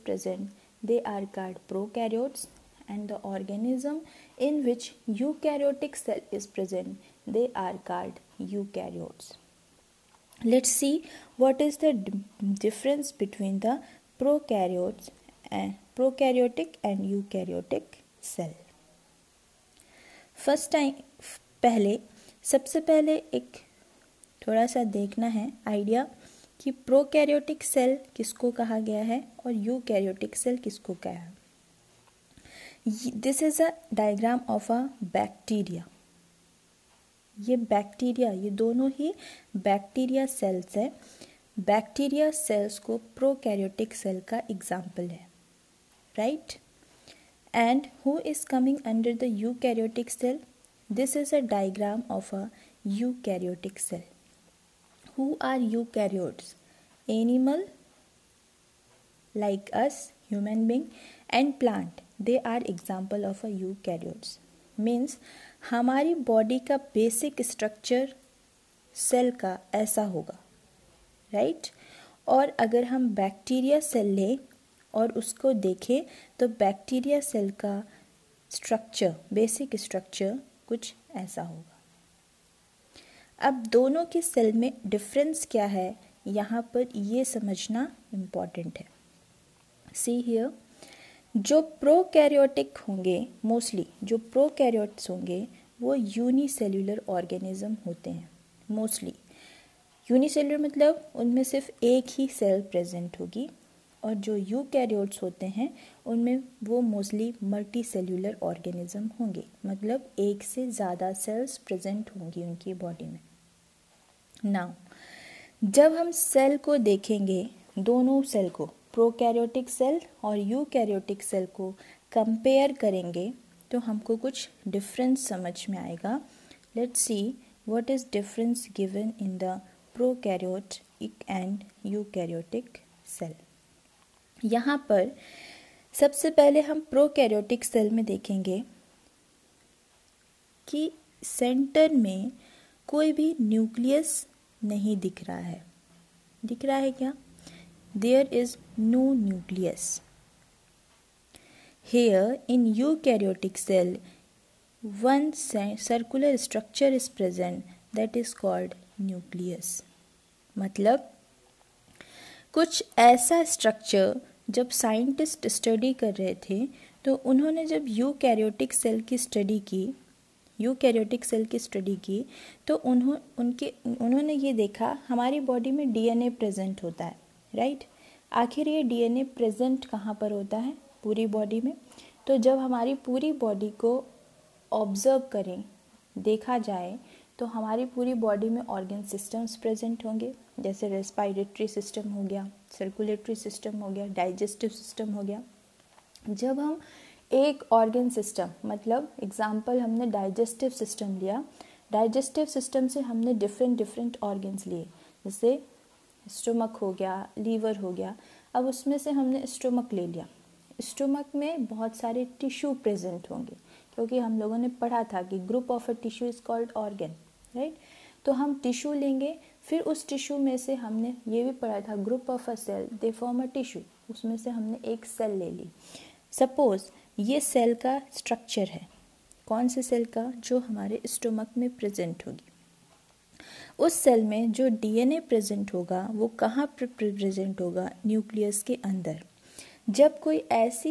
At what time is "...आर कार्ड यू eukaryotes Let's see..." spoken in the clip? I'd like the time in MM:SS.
00:07.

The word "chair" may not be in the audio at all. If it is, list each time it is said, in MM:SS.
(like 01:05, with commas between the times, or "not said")
not said.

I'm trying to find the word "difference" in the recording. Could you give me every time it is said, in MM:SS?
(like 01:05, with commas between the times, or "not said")
00:12.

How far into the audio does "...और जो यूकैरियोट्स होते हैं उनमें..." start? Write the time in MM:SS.
01:44.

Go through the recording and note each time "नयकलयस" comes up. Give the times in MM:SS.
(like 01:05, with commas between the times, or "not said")
02:23, 03:58.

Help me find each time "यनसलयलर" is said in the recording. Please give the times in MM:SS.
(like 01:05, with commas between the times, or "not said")
01:35, 01:40.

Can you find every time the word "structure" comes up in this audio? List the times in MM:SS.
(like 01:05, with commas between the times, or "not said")
02:36.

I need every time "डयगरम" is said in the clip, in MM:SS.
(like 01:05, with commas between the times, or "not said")
00:33, 00:51.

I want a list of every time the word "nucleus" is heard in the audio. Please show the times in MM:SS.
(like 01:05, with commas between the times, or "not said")
02:29, 02:38.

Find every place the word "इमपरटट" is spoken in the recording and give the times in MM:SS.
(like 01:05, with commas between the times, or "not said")
01:28.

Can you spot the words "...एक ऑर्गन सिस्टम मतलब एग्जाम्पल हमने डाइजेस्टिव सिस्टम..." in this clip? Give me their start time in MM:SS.
03:17.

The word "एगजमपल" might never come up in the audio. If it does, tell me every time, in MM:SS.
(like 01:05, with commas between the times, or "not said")
00:44, 01:02, 03:19.